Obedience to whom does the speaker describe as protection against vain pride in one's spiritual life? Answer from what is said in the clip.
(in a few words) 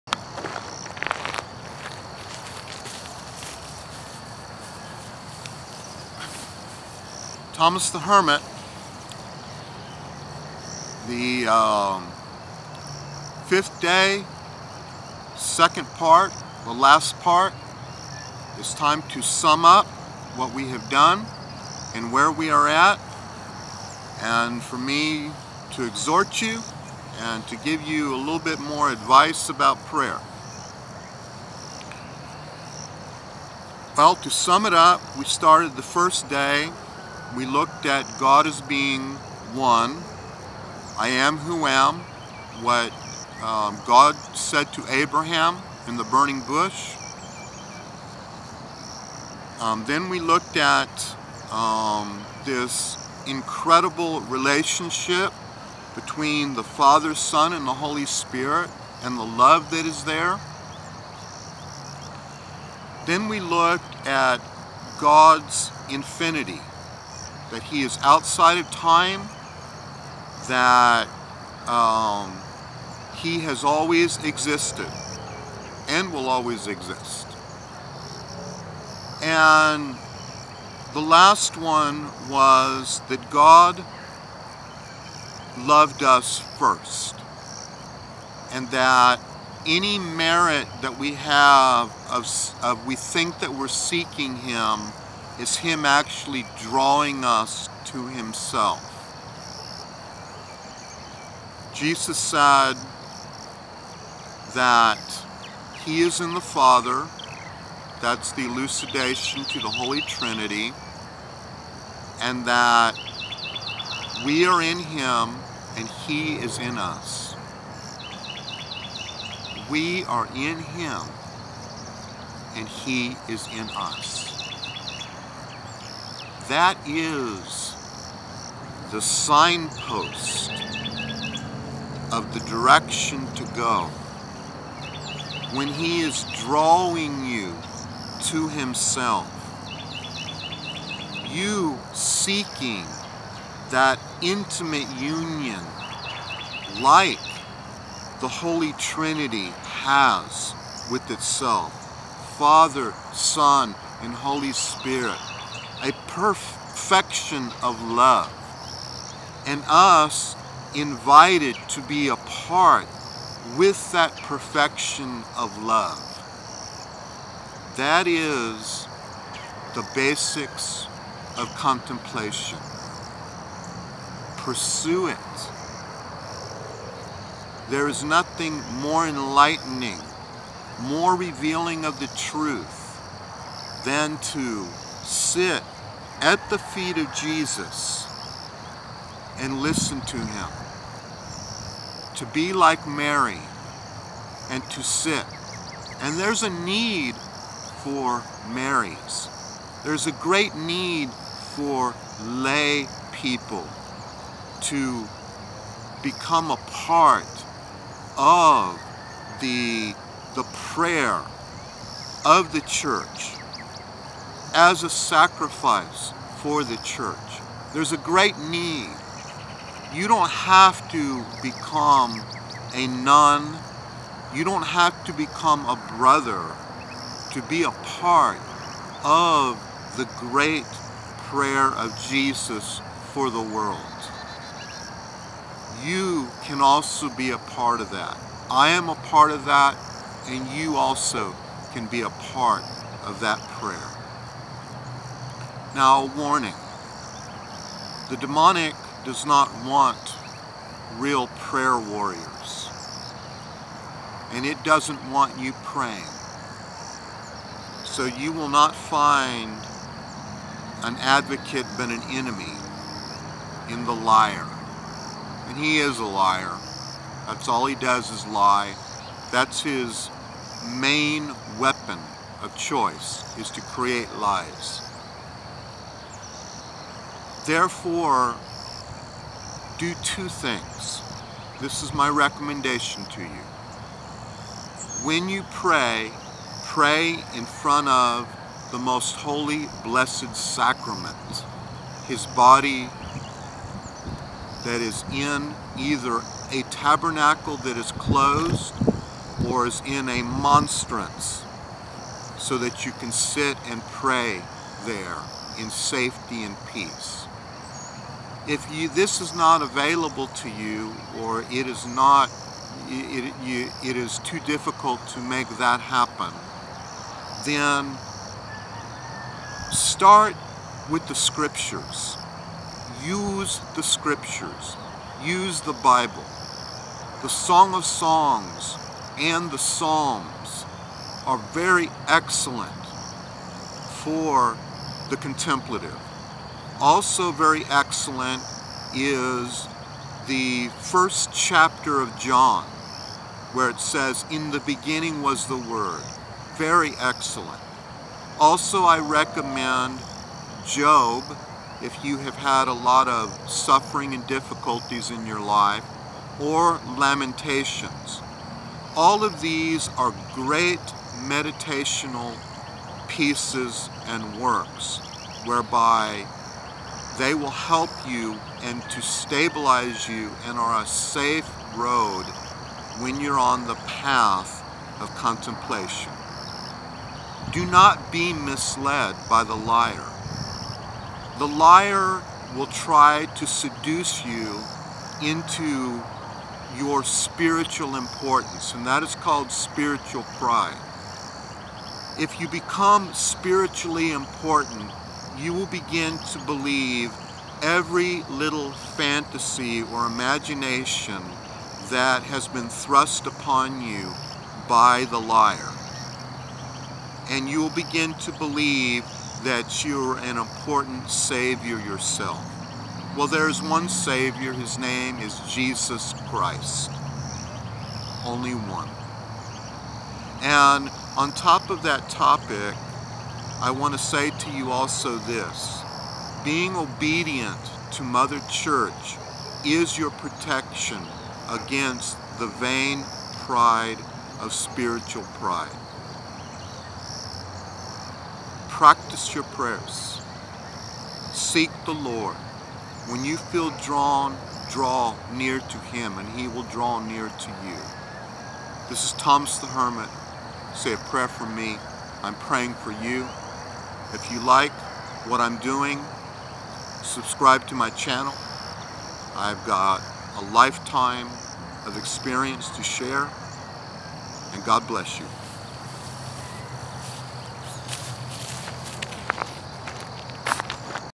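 Mother Church.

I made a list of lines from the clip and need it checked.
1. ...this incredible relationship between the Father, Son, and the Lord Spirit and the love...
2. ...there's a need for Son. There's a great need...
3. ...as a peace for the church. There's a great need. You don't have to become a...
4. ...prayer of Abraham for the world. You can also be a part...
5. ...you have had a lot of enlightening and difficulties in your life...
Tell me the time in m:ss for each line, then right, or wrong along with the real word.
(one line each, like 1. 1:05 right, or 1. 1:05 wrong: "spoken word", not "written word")
1. 0:52 wrong: "Holy", not "Lord"
2. 3:16 wrong: "Marys", not "Son"
3. 3:34 wrong: "sacrifice", not "peace"
4. 3:51 wrong: "Jesus", not "Abraham"
5. 5:52 wrong: "suffering", not "enlightening".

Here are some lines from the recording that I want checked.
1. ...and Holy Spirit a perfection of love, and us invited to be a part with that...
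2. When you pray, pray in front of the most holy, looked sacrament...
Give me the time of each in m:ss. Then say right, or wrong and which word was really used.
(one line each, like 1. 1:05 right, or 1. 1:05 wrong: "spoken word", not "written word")
1. 2:34 right
2. 4:45 wrong: "blessed", not "looked".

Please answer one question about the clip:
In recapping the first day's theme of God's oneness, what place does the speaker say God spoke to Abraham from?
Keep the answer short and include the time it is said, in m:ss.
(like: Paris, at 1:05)
The burning bush, at 0:46.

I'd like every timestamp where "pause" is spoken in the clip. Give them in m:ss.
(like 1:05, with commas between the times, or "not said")
not said.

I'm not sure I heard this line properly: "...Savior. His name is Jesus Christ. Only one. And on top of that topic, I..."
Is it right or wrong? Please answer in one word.
right.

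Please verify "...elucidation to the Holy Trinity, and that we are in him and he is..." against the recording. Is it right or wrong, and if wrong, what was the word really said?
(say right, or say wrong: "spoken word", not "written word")
right.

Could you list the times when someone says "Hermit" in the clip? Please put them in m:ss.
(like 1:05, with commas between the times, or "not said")
0:07, 7:29.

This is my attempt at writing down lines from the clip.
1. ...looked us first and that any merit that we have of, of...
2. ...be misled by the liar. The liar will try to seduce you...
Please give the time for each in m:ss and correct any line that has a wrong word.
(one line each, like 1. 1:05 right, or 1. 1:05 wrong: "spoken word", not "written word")
1. 1:25 wrong: "loved", not "looked"
2. 6:18 right.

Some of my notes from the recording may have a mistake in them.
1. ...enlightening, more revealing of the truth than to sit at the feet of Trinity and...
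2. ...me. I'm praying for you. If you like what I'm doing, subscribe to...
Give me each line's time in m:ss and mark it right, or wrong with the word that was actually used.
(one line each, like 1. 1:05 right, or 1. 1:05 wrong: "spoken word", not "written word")
1. 2:59 wrong: "Jesus", not "Trinity"
2. 7:31 right.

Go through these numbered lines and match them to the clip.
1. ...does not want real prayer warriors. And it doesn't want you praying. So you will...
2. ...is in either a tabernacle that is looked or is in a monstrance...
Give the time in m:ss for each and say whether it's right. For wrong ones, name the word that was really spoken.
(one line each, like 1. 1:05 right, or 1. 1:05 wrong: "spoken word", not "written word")
1. 4:09 right
2. 4:54 wrong: "closed", not "looked".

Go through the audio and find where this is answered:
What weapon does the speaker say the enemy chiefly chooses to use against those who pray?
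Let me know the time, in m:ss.
4:34.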